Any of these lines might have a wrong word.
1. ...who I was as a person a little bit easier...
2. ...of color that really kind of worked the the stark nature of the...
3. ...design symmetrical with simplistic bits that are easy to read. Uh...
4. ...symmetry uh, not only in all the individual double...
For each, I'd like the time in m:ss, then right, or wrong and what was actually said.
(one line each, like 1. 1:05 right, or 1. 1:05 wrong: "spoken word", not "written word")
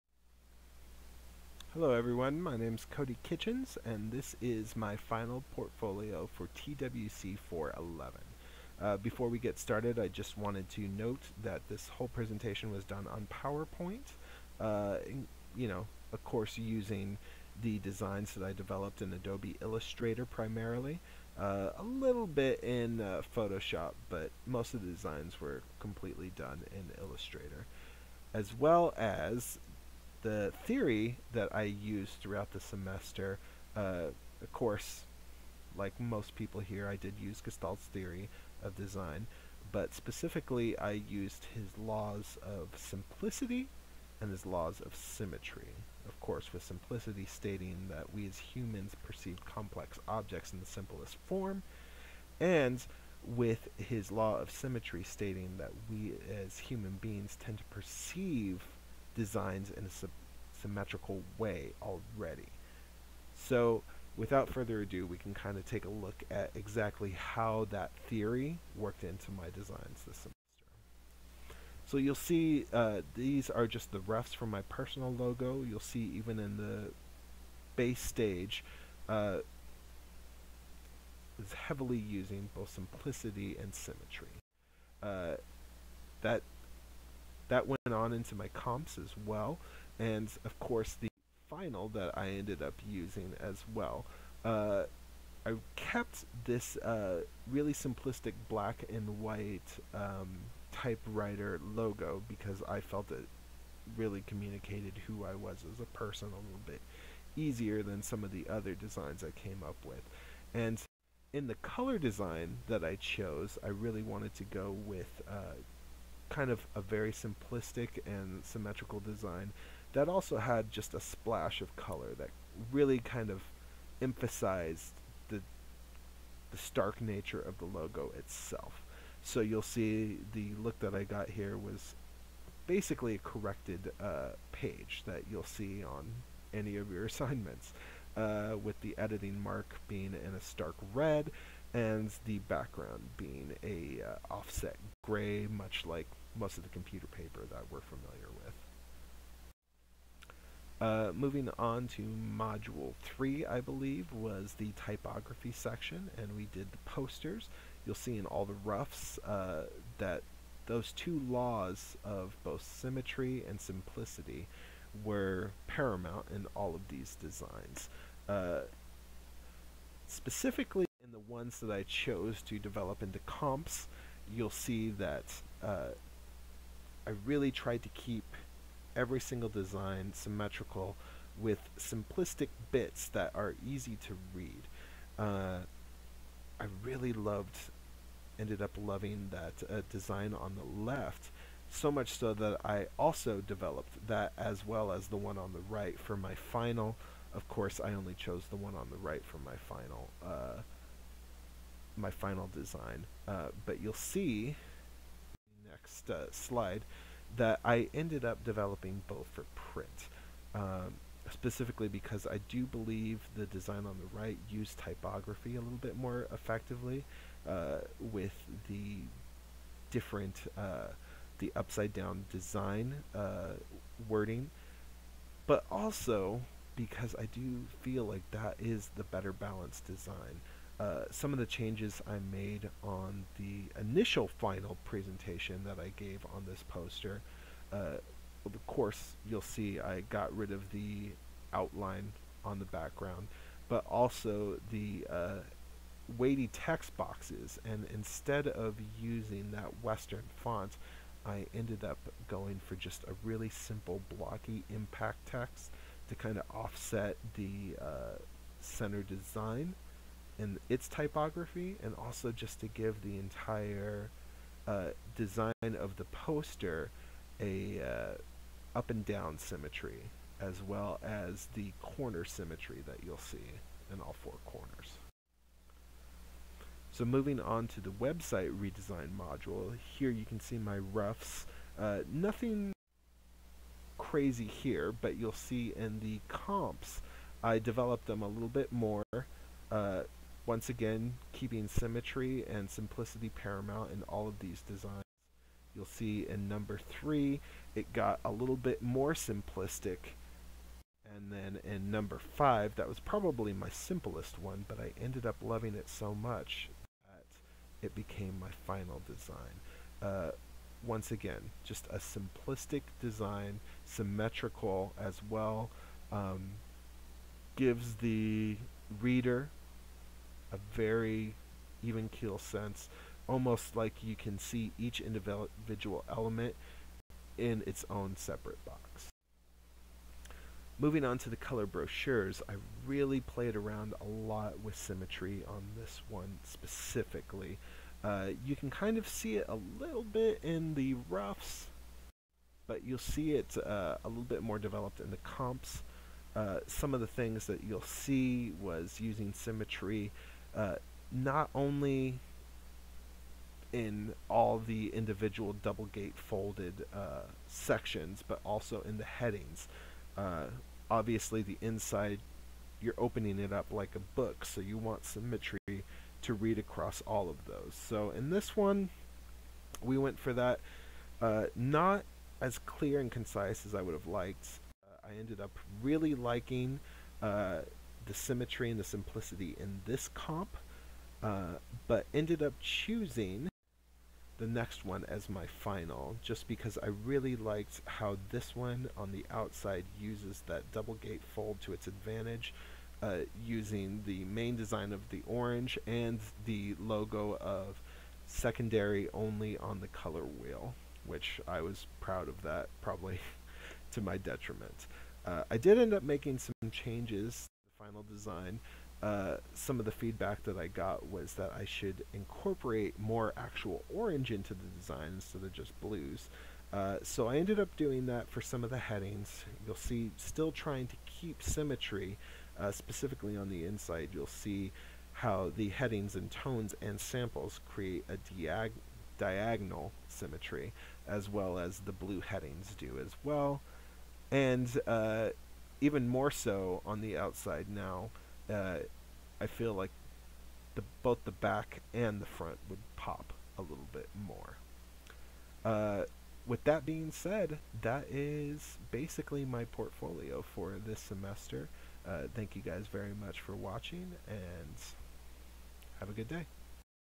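1. 1:45 right
2. 2:01 wrong: "emphasized", not "worked"
3. 2:59 right
4. 5:49 right.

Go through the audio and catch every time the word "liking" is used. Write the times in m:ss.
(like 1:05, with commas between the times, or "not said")
6:16.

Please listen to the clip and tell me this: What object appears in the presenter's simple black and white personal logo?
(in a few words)
typewriter.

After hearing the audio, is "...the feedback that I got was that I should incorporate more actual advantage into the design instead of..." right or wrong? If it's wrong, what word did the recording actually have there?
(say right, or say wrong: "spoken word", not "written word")
wrong: "orange", not "advantage".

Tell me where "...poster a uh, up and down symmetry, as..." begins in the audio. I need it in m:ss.
4:26.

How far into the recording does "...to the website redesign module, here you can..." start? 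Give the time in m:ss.
4:37.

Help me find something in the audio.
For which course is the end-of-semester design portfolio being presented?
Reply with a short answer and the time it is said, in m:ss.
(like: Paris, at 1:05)
TWC 411, at 0:06.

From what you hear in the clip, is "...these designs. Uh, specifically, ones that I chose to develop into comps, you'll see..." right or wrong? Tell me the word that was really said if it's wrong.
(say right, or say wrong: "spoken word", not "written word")
right.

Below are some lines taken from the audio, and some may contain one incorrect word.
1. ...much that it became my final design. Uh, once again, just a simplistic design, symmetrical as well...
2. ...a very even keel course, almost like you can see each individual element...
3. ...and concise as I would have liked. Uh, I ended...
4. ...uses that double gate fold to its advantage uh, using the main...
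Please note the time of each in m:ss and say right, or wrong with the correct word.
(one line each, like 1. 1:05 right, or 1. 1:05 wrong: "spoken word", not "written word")
1. 5:06 right
2. 5:20 wrong: "sense", not "course"
3. 6:12 right
4. 6:29 right.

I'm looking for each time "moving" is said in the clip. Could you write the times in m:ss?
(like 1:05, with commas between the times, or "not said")
2:31, 4:37, 5:30.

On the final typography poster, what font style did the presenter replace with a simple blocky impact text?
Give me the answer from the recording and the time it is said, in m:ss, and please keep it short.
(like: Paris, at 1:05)
Western, at 4:09.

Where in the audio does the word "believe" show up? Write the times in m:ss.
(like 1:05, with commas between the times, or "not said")
2:33, 3:32.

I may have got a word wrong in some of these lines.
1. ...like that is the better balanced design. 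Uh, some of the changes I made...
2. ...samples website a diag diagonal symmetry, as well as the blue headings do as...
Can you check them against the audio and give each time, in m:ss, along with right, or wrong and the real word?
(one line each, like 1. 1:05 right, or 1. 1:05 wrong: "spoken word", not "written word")
1. 3:48 right
2. 7:07 wrong: "create", not "website".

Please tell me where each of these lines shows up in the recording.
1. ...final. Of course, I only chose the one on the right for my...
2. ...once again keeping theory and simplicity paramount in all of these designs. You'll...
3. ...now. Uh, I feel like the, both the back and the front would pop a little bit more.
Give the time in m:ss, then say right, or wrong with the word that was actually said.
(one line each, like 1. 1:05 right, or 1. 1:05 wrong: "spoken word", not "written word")
1. 3:16 right
2. 4:50 wrong: "symmetry", not "theory"
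3. 7:17 right.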